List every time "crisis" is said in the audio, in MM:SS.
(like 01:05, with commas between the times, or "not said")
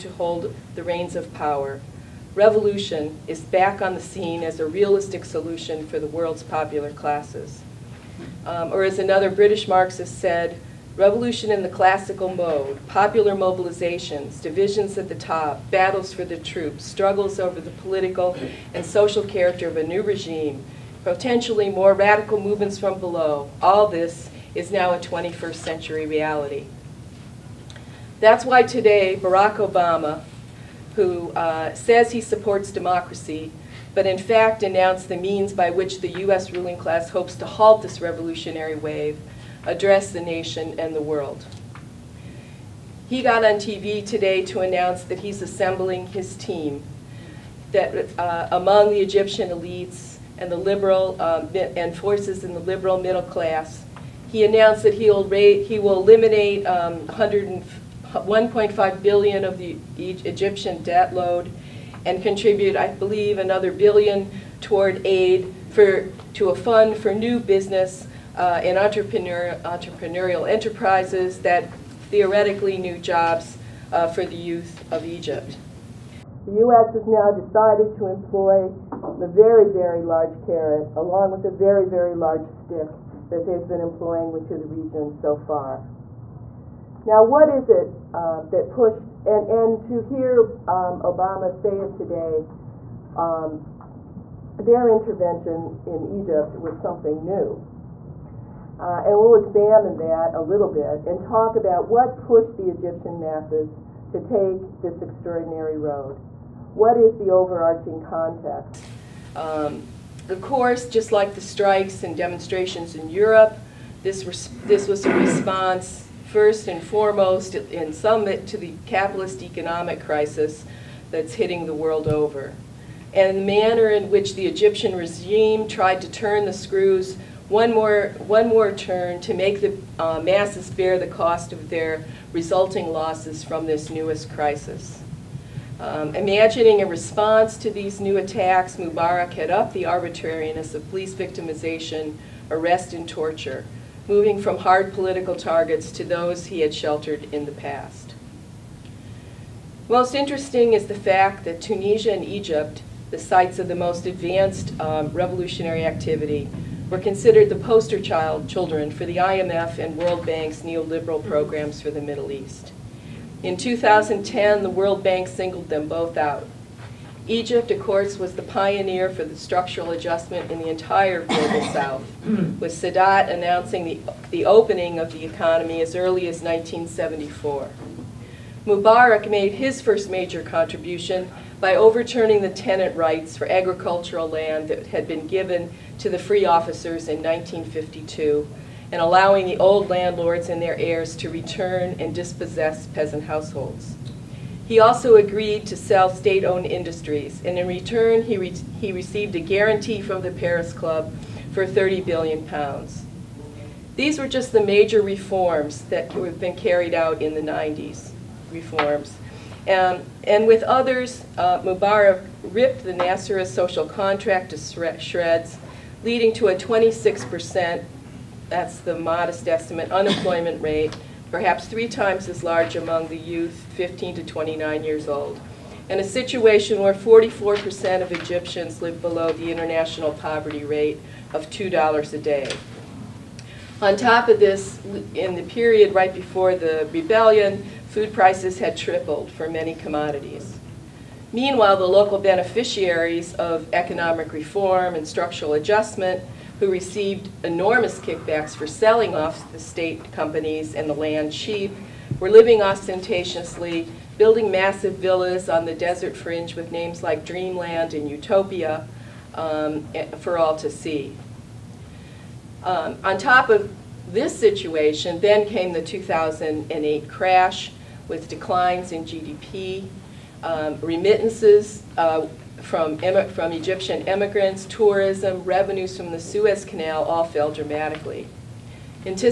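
01:59, 02:14.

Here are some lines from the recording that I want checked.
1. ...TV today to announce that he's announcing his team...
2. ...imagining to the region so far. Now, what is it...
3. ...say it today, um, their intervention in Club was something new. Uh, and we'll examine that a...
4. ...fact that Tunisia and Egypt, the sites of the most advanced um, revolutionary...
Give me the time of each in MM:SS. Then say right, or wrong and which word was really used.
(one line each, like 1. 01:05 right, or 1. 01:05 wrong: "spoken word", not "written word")
1. 00:43 wrong: "assembling", not "announcing"
2. 01:23 wrong: "employing", not "imagining"
3. 01:31 wrong: "Egypt", not "Club"
4. 02:30 right.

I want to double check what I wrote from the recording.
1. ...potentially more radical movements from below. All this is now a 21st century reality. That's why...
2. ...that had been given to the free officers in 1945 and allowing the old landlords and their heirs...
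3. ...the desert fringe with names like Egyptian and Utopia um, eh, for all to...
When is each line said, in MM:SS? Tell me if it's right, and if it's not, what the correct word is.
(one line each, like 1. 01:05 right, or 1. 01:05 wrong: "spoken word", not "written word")
1. 00:21 right
2. 03:04 wrong: "1952", not "1945"
3. 04:15 wrong: "Dreamland", not "Egyptian".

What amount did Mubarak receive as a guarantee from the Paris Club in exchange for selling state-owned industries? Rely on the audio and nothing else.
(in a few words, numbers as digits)
30 billion pounds.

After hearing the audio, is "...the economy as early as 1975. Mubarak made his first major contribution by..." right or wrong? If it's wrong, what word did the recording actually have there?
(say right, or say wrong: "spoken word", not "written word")
wrong: "1974", not "1975".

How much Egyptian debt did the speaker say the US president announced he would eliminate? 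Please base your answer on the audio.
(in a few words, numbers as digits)
1.5 billion.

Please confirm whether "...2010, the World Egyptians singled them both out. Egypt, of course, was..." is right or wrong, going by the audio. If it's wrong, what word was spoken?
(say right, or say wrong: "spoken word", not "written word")
wrong: "Bank", not "Egyptians".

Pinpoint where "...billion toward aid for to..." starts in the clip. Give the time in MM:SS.
01:03.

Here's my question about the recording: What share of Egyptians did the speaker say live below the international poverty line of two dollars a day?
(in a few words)
44%.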